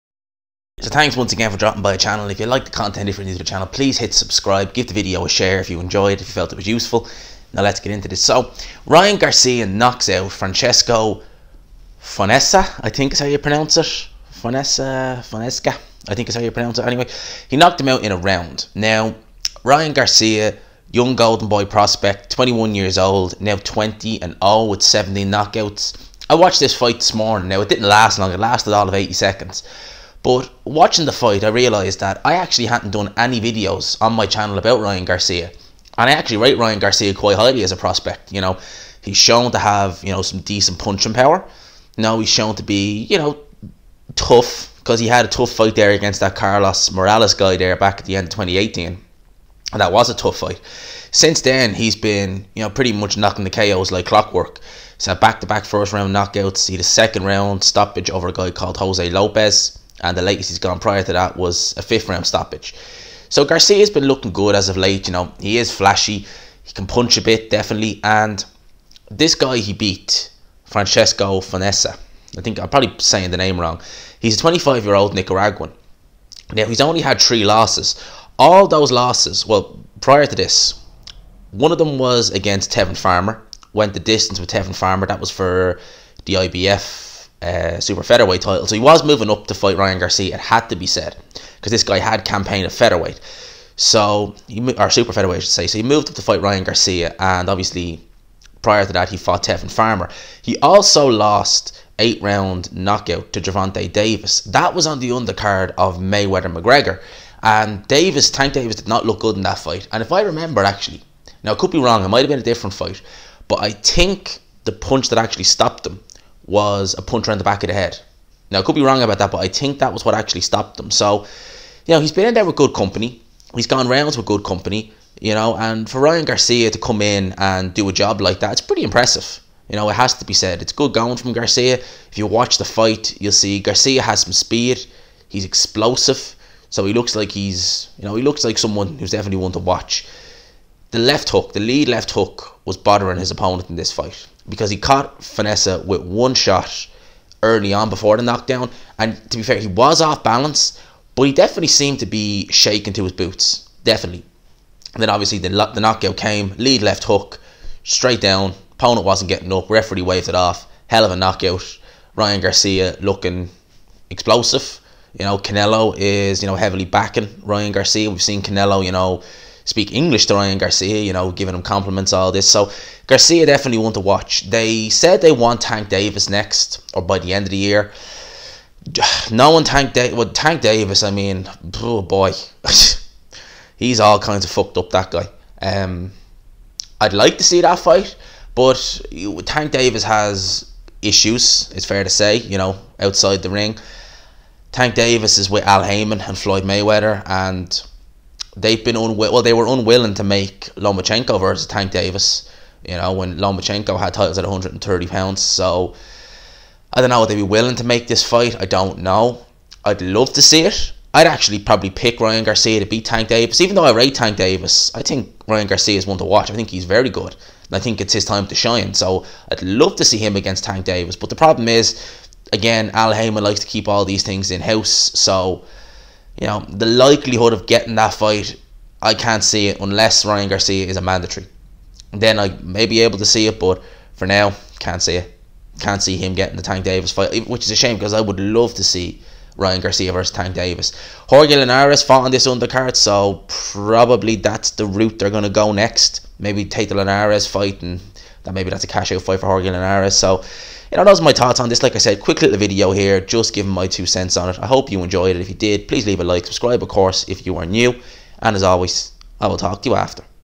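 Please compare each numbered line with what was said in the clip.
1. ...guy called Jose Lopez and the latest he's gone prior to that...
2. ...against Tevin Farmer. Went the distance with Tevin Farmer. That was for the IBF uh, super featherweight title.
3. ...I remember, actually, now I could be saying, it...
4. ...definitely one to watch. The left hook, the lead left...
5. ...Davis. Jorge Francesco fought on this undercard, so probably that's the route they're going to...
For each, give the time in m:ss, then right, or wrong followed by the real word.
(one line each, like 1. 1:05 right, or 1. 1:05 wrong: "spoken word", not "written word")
1. 0:58 right
2. 1:22 right
3. 1:50 wrong: "wrong", not "saying"
4. 2:19 right
5. 4:00 wrong: "Linares", not "Francesco".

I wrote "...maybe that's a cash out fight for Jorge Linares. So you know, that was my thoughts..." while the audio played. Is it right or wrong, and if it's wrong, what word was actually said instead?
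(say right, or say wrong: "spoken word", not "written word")
right.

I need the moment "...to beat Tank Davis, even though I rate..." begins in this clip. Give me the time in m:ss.
3:32.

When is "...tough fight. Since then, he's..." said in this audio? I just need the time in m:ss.
0:50.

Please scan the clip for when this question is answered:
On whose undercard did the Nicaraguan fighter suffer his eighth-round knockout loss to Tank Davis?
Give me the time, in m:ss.
1:45.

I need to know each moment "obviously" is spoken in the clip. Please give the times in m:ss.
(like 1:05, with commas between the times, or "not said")
1:37, 2:35.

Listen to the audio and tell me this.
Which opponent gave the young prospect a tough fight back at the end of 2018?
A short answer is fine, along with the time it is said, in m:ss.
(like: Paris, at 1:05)
Carlos Morales, at 0:46.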